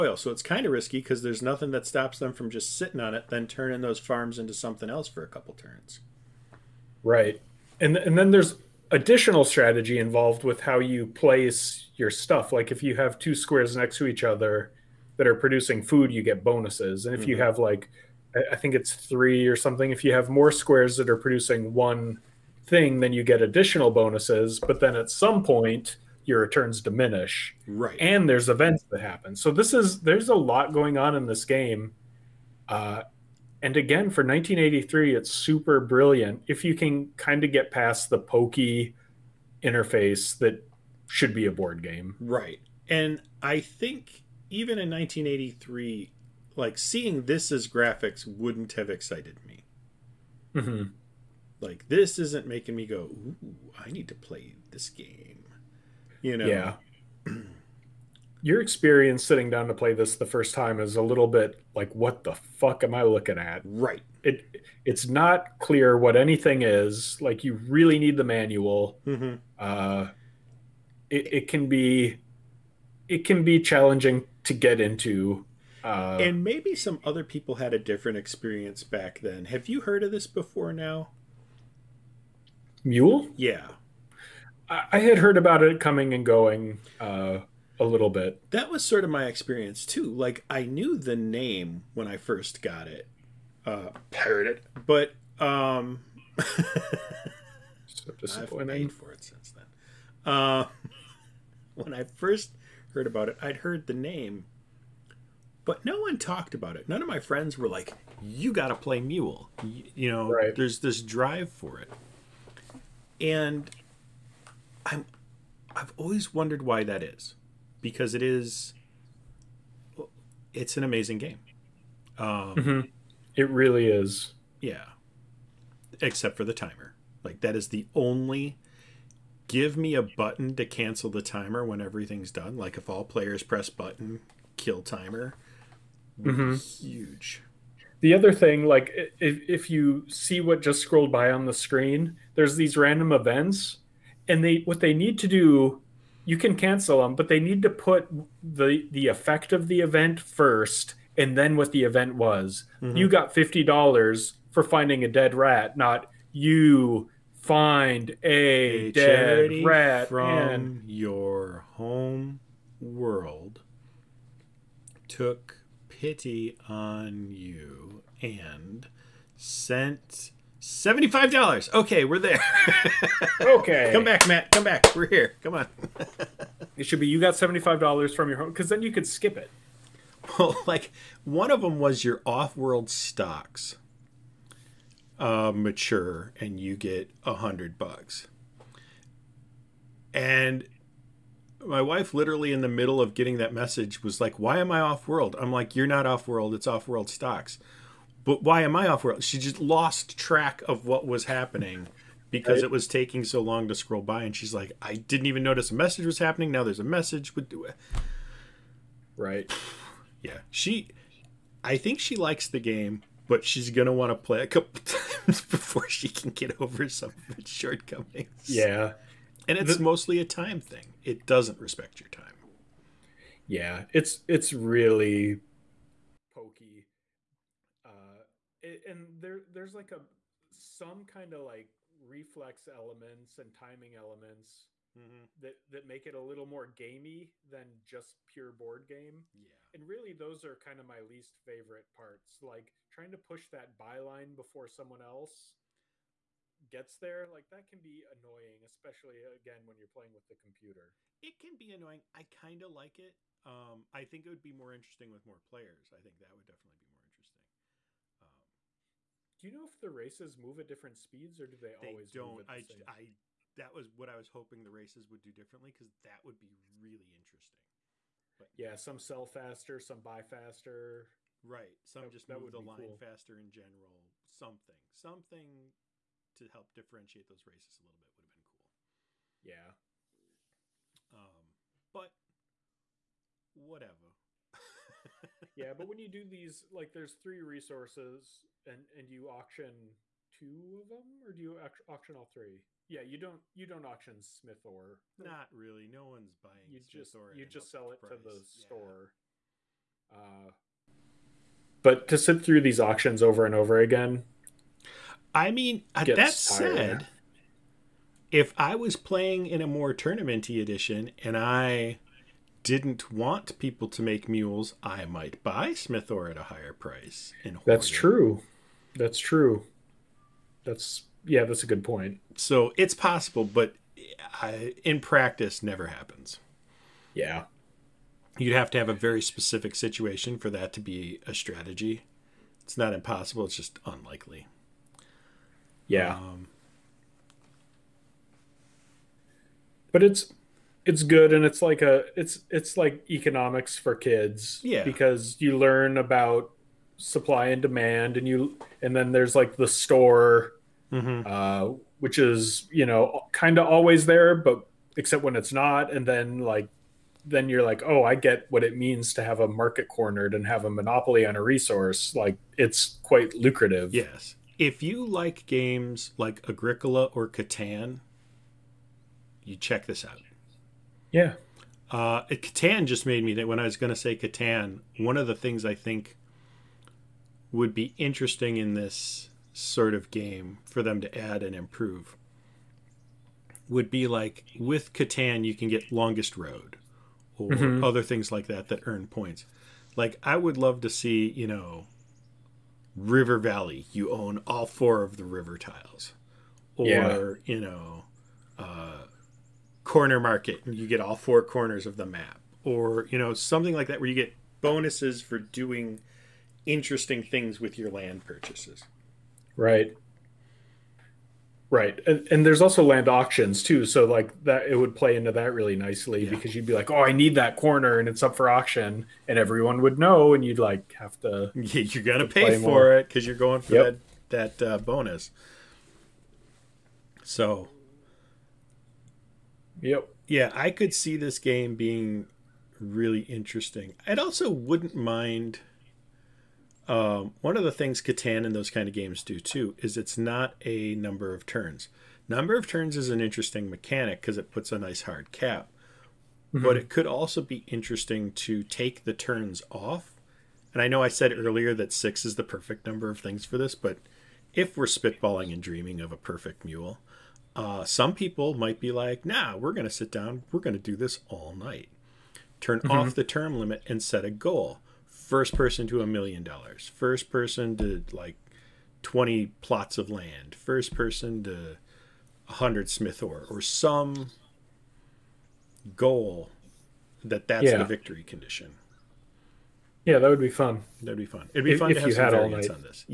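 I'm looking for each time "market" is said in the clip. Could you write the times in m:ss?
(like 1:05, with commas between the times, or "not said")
5:59, 6:40.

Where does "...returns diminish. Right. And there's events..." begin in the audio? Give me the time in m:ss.
0:26.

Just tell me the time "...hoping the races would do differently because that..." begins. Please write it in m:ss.
4:24.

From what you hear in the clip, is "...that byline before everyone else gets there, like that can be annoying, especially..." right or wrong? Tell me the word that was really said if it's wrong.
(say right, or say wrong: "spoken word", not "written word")
wrong: "someone", not "everyone".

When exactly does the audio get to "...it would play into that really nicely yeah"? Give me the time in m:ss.
6:54.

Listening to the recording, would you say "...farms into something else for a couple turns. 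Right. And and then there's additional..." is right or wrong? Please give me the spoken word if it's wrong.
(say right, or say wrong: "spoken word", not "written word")
right.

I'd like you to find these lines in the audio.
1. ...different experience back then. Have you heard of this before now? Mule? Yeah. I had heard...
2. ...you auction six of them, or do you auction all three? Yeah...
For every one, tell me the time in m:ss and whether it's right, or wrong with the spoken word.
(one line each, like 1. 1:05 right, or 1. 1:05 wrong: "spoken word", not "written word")
1. 1:17 right
2. 4:49 wrong: "two", not "six".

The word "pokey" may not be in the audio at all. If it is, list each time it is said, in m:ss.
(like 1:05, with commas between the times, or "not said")
0:38, 3:46.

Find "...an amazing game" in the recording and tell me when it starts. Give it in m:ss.
2:00.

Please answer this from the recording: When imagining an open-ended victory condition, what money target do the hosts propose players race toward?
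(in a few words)
a million dollars.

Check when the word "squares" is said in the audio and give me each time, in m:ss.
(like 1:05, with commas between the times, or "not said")
0:13, 0:20.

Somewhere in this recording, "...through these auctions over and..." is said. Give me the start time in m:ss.
5:02.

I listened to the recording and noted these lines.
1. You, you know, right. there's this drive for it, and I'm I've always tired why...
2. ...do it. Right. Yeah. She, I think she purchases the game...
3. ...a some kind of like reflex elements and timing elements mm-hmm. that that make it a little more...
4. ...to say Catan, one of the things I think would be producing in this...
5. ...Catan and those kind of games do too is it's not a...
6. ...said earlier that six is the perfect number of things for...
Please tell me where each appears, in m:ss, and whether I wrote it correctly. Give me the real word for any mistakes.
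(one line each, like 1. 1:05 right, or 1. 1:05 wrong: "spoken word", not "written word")
1. 1:49 wrong: "wondered", not "tired"
2. 3:27 wrong: "likes", not "purchases"
3. 3:49 right
4. 6:13 wrong: "interesting", not "producing"
5. 7:18 right
6. 7:31 right.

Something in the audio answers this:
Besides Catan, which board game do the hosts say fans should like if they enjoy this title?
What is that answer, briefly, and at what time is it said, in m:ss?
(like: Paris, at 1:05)
Agricola, at 6:06.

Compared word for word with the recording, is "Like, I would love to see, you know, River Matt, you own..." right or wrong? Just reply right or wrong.
wrong.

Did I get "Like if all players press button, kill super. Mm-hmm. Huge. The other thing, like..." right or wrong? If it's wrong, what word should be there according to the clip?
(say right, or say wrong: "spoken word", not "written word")
wrong: "timer", not "super".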